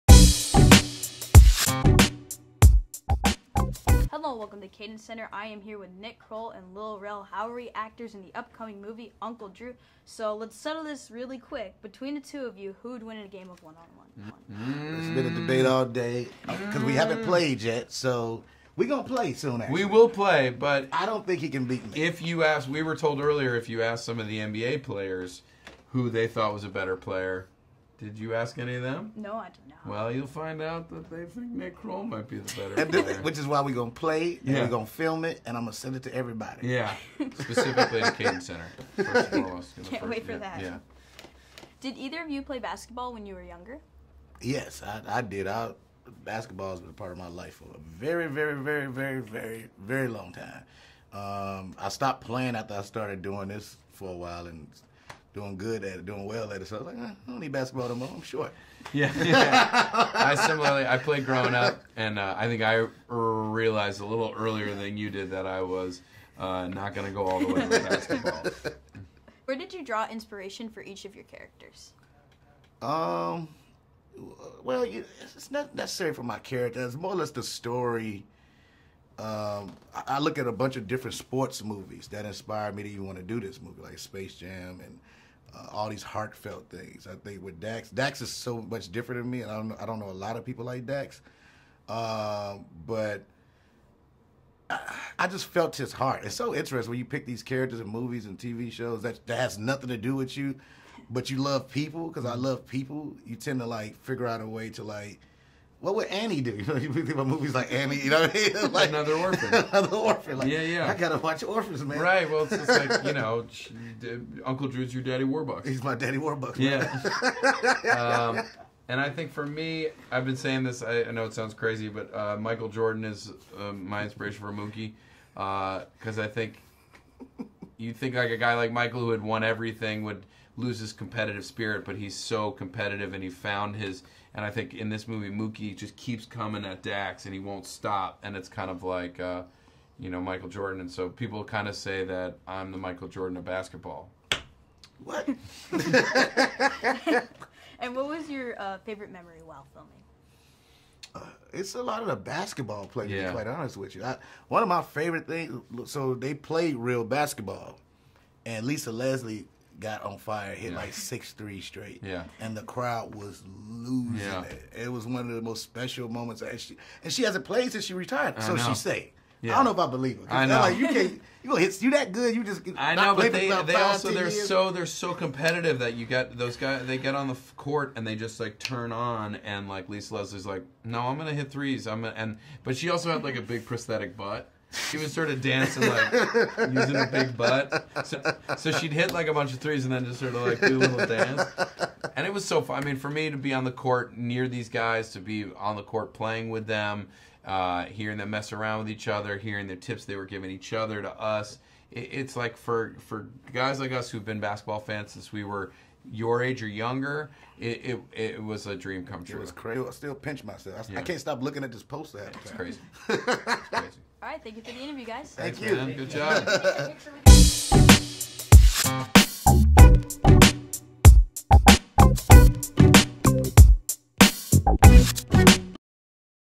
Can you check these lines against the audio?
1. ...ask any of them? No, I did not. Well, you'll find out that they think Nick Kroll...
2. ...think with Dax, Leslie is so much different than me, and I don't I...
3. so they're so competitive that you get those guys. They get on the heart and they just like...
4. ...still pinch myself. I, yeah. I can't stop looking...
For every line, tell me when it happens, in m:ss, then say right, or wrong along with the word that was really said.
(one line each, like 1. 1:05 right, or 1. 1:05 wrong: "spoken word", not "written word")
1. 0:28 right
2. 1:27 wrong: "Dax", not "Leslie"
3. 2:54 wrong: "court", not "heart"
4. 3:29 right.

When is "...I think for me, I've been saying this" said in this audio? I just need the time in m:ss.
1:59.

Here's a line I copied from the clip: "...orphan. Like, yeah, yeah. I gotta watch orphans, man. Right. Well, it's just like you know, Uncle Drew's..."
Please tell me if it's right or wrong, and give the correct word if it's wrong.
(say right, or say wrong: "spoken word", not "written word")
right.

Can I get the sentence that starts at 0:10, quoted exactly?
So let's settle this really quick.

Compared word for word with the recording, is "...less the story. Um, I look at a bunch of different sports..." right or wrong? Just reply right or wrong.
right.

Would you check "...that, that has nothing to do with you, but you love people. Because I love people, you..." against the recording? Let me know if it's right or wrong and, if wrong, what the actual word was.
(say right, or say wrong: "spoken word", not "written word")
right.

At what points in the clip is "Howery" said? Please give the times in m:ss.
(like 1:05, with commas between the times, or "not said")
0:07.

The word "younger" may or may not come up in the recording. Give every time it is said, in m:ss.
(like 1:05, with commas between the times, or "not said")
0:43, 3:26.